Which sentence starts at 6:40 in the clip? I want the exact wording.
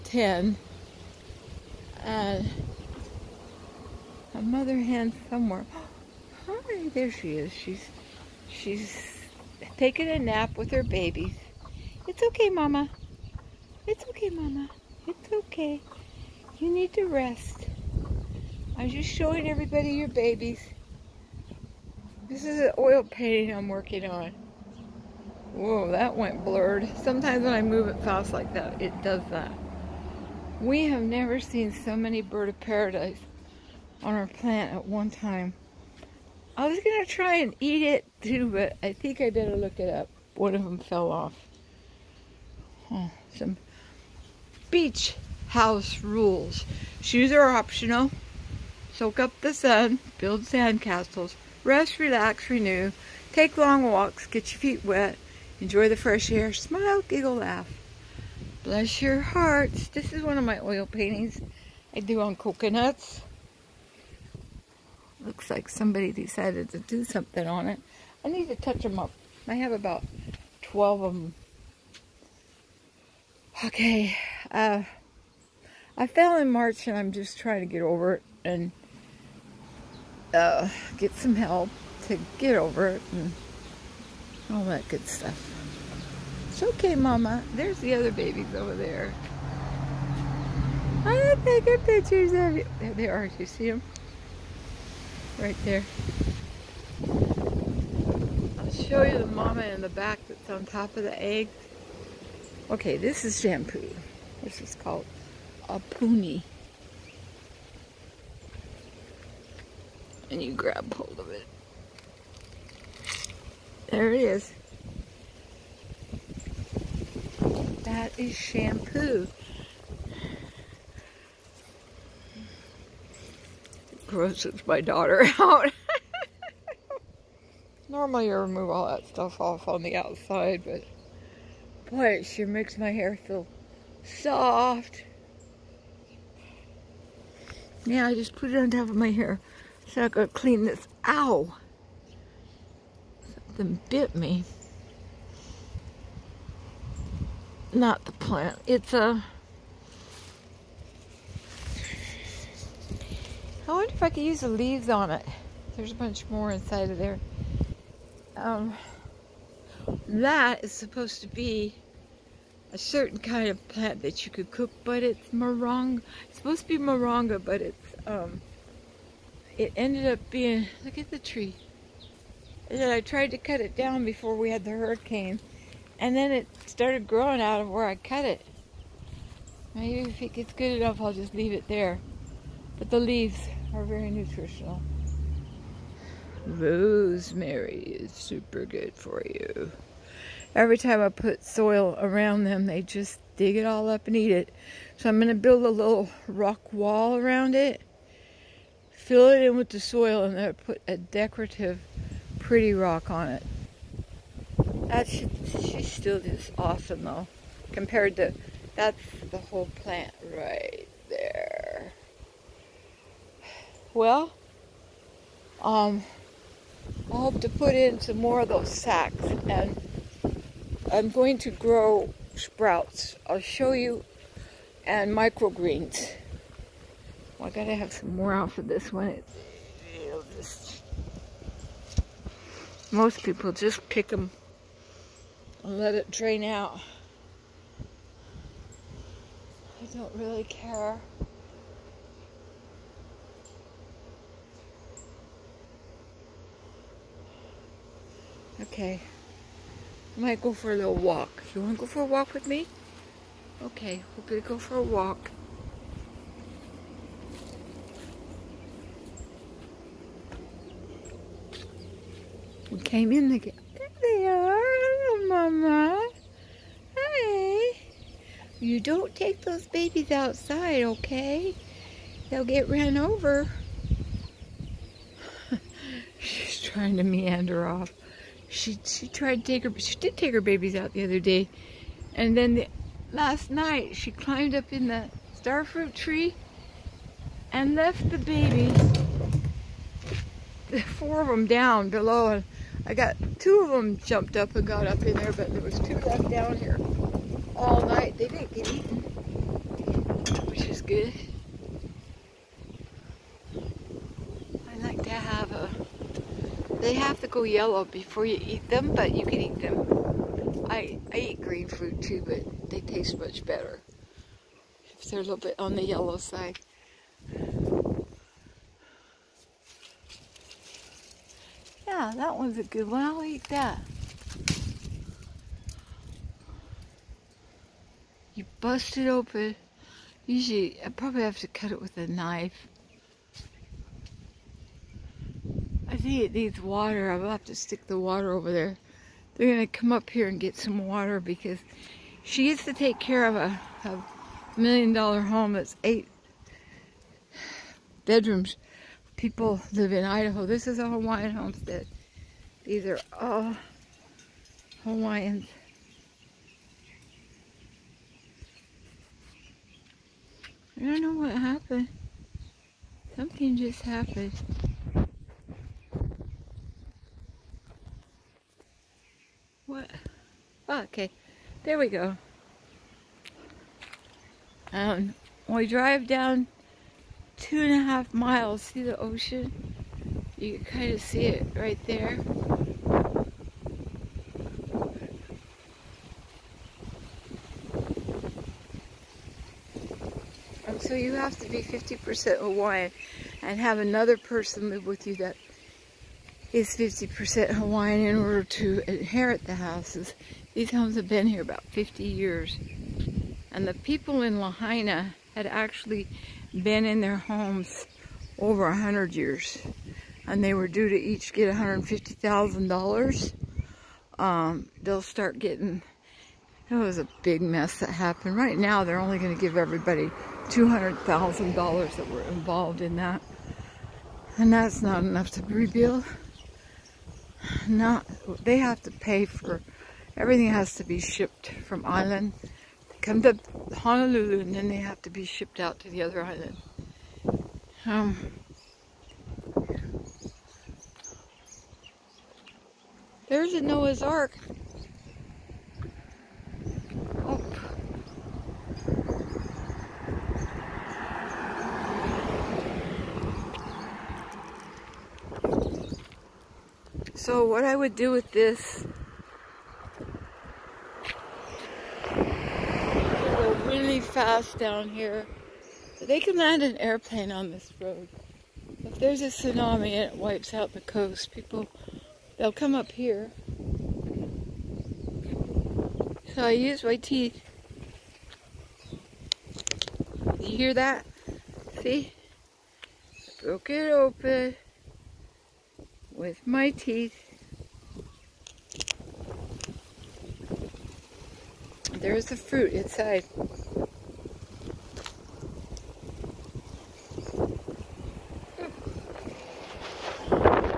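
These homes have been here about 50 years.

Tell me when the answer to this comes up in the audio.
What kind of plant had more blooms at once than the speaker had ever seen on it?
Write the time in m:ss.
0:32.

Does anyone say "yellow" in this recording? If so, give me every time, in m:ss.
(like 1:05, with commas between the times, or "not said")
5:07, 5:15.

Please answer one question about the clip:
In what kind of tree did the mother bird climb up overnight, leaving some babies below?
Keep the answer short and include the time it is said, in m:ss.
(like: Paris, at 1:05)
Starfruit tree, at 4:45.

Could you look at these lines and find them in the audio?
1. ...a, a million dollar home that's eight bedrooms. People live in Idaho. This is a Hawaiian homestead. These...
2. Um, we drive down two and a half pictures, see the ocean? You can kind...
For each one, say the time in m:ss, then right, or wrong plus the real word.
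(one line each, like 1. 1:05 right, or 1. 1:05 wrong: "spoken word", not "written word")
1. 5:43 right
2. 6:14 wrong: "miles", not "pictures".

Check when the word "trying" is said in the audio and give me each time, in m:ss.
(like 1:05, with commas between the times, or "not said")
1:17, 4:36.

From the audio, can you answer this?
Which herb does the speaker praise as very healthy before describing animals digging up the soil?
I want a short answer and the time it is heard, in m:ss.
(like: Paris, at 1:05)
Rosemary, at 3:06.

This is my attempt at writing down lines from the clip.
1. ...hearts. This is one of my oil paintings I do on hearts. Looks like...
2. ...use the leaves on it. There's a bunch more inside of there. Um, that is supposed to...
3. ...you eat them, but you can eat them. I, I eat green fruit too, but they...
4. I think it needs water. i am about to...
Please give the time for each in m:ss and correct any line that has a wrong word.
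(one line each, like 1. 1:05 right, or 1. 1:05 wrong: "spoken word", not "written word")
1. 0:59 wrong: "coconuts", not "hearts"
2. 2:34 right
3. 5:08 right
4. 5:35 right.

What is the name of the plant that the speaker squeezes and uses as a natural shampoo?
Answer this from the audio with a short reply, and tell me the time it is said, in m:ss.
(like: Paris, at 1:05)
Poonie, at 1:45.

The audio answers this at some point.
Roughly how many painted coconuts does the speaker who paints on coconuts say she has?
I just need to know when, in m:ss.
1:10.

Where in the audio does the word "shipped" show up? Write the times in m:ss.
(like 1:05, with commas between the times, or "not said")
7:10, 7:15.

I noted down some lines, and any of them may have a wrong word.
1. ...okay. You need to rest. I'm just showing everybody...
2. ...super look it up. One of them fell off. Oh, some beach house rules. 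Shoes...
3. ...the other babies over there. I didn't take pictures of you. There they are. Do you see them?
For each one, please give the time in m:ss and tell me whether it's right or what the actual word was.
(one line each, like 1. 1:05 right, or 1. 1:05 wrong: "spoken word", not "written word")
1. 0:15 right
2. 0:39 wrong: "better", not "super"
3. 1:27 right.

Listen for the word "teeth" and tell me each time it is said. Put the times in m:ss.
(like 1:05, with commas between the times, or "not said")
7:56, 8:06.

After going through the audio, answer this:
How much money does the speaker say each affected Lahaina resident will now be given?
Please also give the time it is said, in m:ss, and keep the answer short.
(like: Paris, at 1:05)
$200,000, at 7:00.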